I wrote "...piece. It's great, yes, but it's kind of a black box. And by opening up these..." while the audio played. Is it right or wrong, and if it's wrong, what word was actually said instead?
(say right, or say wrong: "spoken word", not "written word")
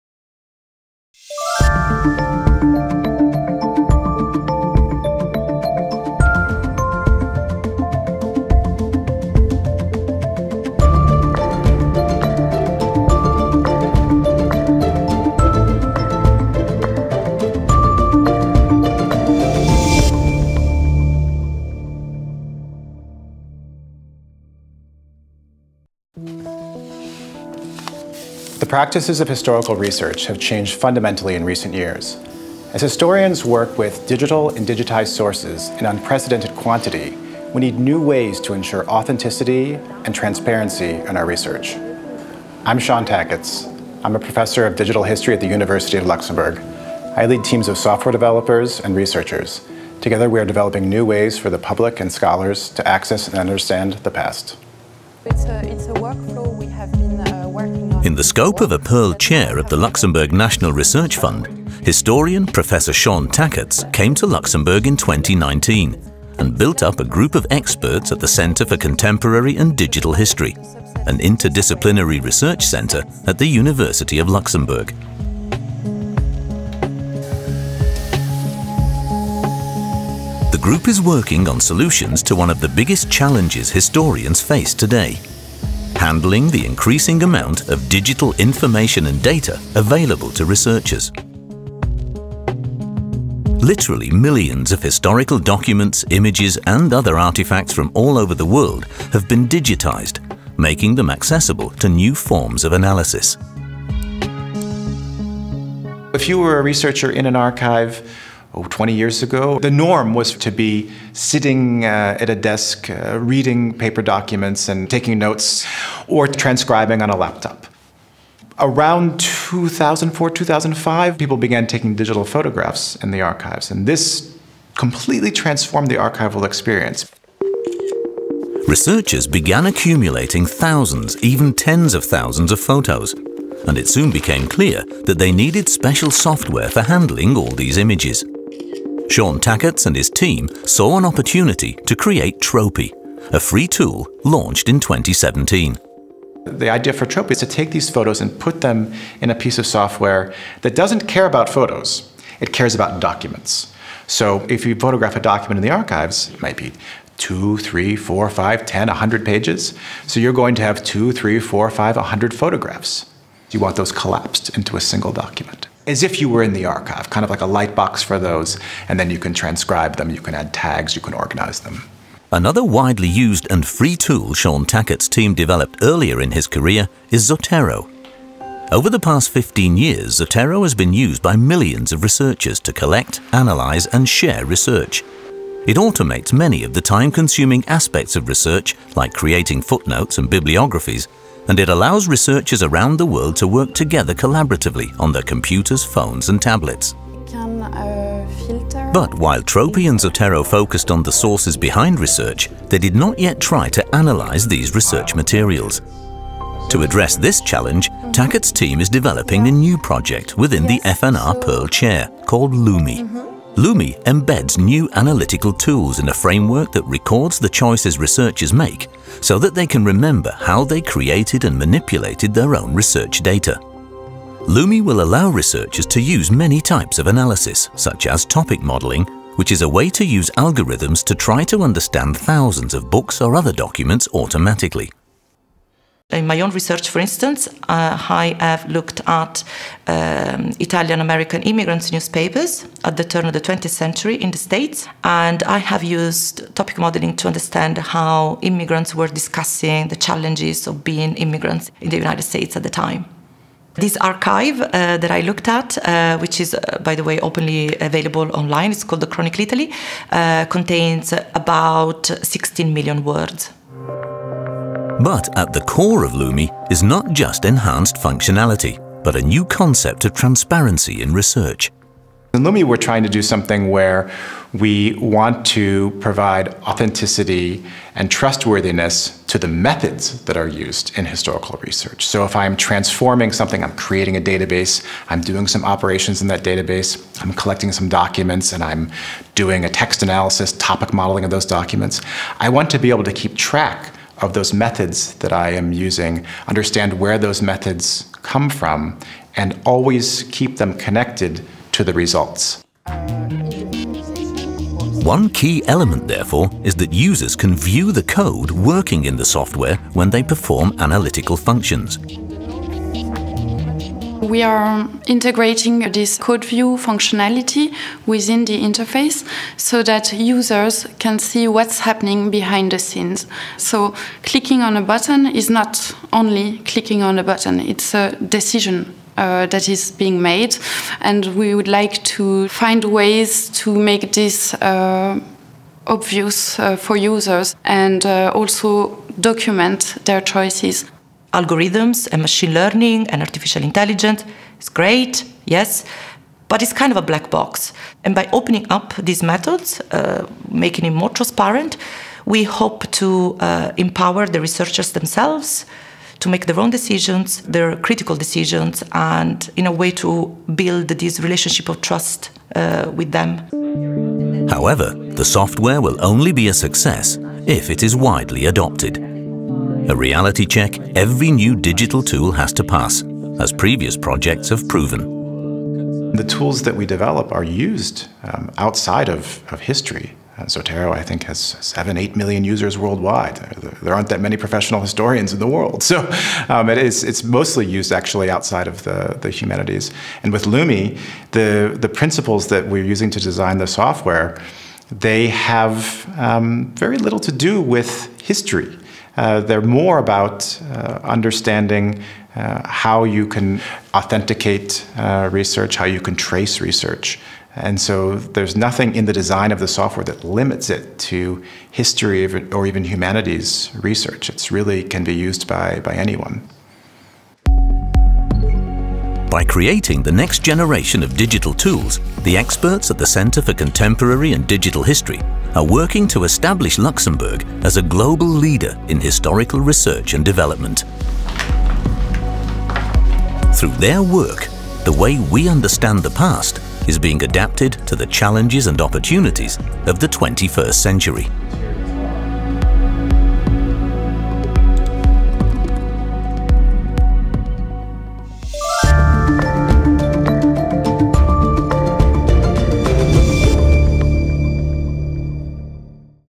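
wrong: "intelligence", not "piece".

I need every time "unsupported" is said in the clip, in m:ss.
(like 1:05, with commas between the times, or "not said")
not said.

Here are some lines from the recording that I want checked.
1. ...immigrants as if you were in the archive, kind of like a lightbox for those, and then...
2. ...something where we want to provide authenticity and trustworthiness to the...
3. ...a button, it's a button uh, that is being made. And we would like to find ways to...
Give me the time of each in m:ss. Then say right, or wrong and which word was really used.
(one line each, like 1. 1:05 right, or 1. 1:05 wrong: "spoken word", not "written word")
1. 2:45 wrong: "document", not "immigrants"
2. 4:33 right
3. 5:27 wrong: "decision", not "button".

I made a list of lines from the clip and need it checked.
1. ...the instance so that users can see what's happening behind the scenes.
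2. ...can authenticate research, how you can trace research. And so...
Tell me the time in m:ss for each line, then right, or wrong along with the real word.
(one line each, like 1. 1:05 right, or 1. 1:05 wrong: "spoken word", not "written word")
1. 5:18 wrong: "interface", not "instance"
2. 6:43 right.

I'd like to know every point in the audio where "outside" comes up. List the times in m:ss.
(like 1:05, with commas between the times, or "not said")
6:18, 6:28.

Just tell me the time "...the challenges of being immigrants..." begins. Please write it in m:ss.
4:09.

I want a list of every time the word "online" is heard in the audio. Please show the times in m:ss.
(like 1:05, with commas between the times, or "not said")
4:18.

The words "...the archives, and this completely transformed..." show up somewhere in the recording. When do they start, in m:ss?
2:03.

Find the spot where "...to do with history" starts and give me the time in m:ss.
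6:37.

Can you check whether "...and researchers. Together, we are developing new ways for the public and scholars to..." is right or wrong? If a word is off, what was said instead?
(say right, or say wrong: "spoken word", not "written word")
right.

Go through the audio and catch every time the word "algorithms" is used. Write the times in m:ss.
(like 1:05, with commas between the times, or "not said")
3:50, 5:41.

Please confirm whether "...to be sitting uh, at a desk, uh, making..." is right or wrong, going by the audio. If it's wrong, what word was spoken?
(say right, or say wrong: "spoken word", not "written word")
wrong: "reading", not "making".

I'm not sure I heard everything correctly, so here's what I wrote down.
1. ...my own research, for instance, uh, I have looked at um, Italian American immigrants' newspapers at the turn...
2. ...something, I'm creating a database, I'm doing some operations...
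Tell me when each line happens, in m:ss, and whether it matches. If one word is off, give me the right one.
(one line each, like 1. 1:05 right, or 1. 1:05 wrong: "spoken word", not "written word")
1. 3:56 right
2. 4:43 right.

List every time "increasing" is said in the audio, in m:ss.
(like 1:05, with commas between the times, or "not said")
1:26.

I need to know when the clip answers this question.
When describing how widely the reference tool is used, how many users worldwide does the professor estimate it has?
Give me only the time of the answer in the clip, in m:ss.
6:21.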